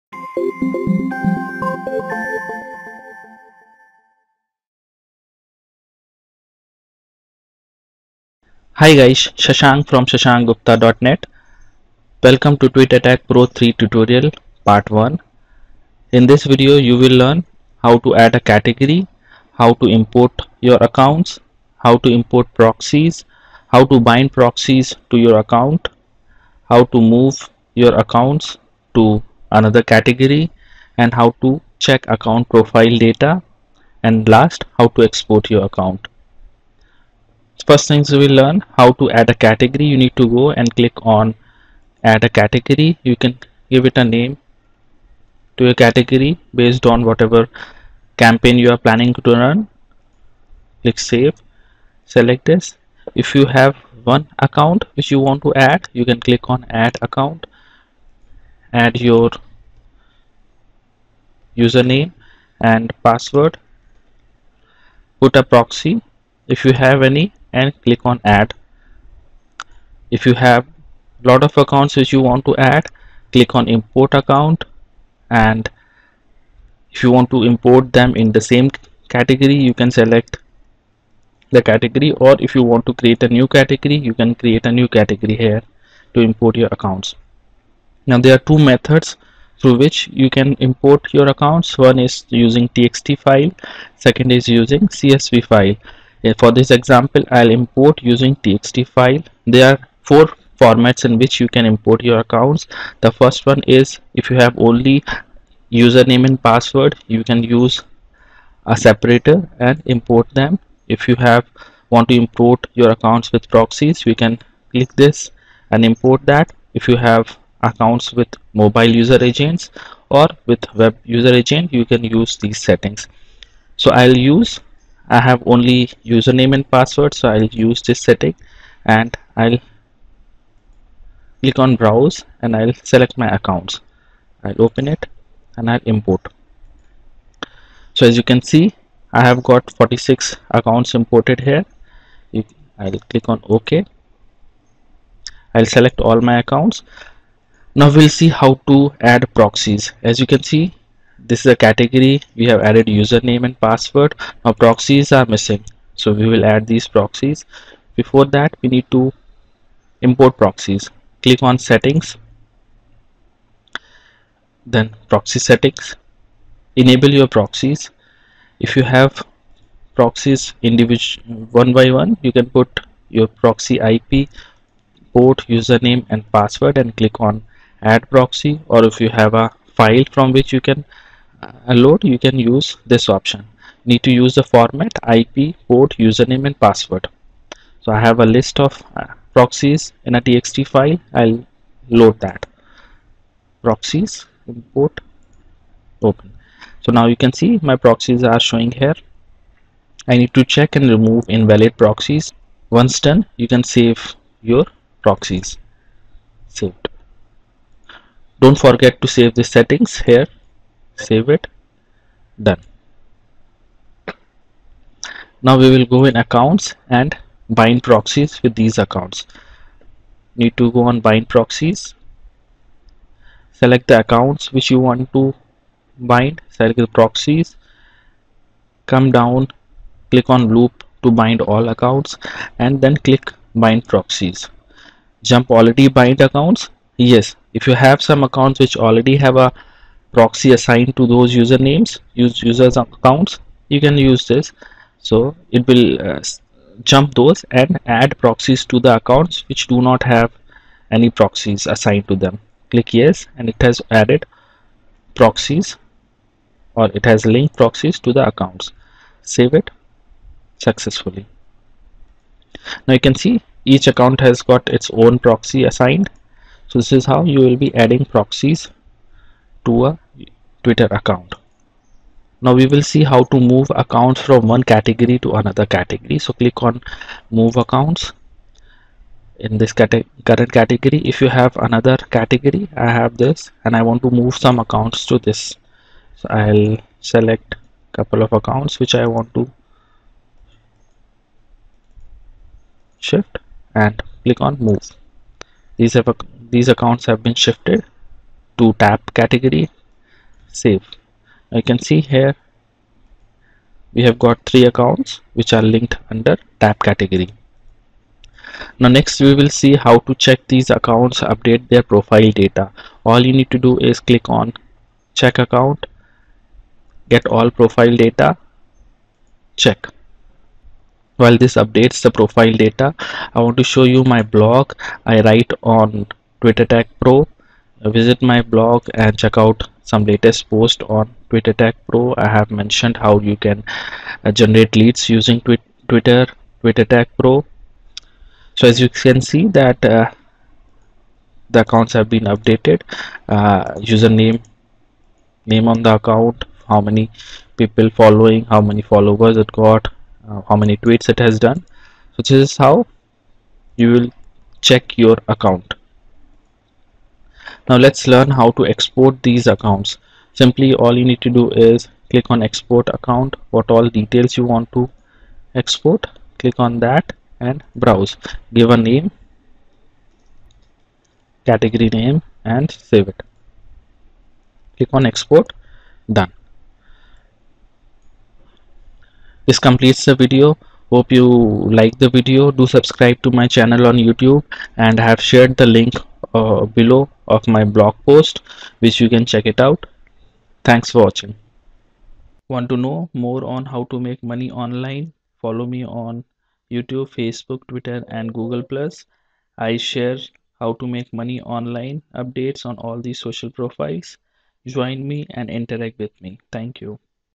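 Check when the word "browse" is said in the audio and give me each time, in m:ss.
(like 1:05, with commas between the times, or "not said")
2:11, 6:07.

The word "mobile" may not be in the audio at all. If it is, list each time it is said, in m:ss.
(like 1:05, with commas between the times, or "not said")
1:58.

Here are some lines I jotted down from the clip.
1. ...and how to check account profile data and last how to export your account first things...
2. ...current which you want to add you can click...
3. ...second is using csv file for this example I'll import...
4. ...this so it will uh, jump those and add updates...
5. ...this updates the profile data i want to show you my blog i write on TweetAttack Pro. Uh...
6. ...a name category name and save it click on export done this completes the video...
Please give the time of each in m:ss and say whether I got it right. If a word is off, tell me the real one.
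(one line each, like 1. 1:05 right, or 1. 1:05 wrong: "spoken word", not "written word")
1. 0:30 right
2. 0:54 wrong: "account", not "current"
3. 1:34 right
4. 4:04 wrong: "proxies", not "updates"
5. 5:21 right
6. 6:08 right.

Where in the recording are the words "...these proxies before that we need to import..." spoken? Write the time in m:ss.
2:36.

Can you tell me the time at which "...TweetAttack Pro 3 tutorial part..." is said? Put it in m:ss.
0:12.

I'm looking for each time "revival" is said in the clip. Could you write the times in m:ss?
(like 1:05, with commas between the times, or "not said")
not said.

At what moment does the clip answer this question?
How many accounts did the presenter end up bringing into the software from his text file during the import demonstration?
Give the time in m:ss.
2:19.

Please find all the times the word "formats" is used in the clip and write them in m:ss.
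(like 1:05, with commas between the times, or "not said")
1:40, 3:04.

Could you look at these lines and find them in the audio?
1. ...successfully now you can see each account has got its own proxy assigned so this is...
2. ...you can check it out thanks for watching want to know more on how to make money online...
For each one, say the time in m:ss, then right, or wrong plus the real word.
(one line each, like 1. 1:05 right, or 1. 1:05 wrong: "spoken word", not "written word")
1. 4:20 right
2. 6:29 right.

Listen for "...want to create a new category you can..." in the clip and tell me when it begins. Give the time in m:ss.
1:22.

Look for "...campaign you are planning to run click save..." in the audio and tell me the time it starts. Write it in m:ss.
0:48.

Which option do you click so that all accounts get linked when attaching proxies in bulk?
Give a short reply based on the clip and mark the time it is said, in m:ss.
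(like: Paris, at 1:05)
loop, at 3:50.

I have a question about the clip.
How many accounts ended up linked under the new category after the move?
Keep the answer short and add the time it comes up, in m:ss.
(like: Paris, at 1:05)
3, at 5:04.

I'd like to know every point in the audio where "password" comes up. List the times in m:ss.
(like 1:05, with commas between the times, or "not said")
1:03, 1:46, 2:06, 2:33, 2:56, 3:06.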